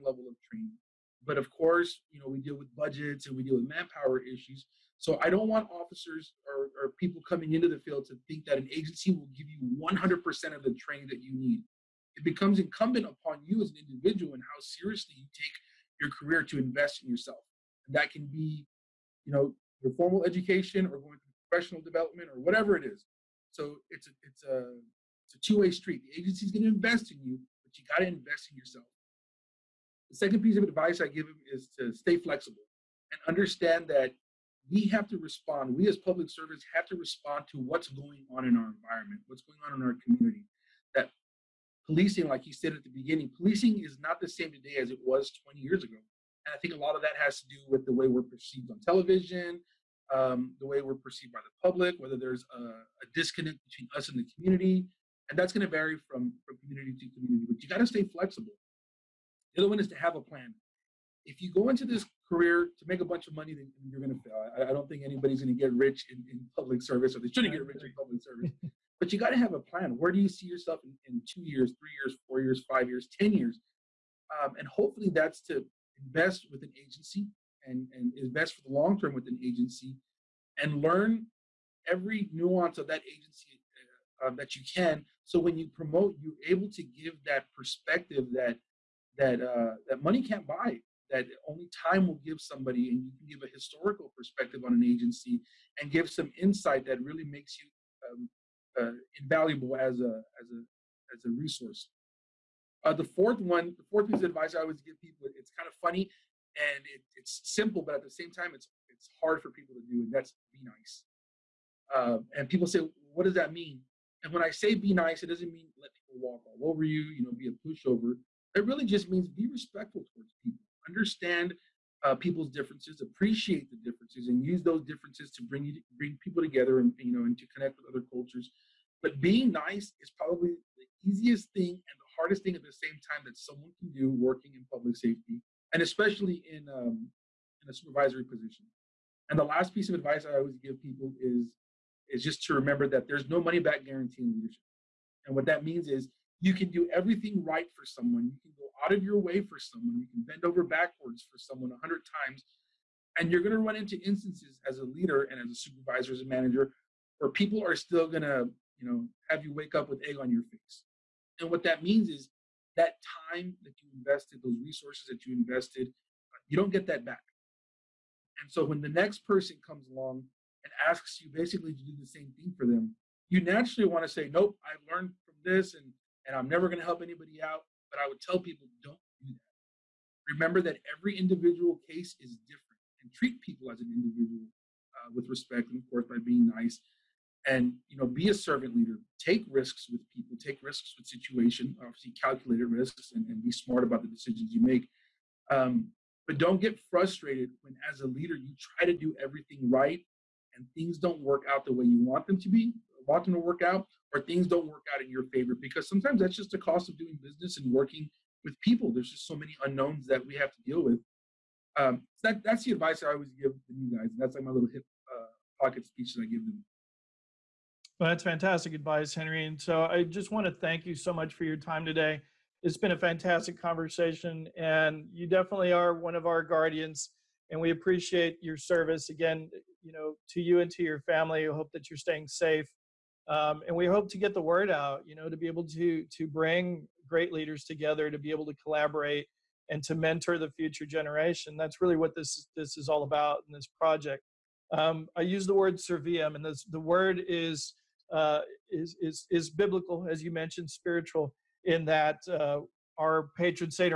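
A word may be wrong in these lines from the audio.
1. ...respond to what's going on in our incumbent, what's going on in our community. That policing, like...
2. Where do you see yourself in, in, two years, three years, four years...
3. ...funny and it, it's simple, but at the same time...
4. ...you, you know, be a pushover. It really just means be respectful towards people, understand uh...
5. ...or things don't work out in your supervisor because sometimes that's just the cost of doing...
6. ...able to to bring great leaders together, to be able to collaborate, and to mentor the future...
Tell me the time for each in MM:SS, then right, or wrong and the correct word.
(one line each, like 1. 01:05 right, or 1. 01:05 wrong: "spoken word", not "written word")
1. 00:36 wrong: "environment", not "incumbent"
2. 01:09 right
3. 01:45 right
4. 01:56 right
5. 03:24 wrong: "favor", not "supervisor"
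6. 03:55 right.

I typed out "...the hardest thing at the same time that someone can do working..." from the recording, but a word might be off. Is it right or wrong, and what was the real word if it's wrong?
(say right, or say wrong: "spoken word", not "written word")
right.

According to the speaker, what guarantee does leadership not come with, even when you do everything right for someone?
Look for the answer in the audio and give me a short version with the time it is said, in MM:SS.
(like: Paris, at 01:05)
Money back guarantee, at 02:23.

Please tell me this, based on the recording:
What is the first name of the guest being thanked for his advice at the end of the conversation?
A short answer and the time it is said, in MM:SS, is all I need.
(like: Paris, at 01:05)
Henry, at 03:39.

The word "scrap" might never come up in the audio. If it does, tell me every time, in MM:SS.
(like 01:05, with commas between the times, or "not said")
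not said.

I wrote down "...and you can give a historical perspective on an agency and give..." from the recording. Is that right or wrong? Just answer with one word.
right.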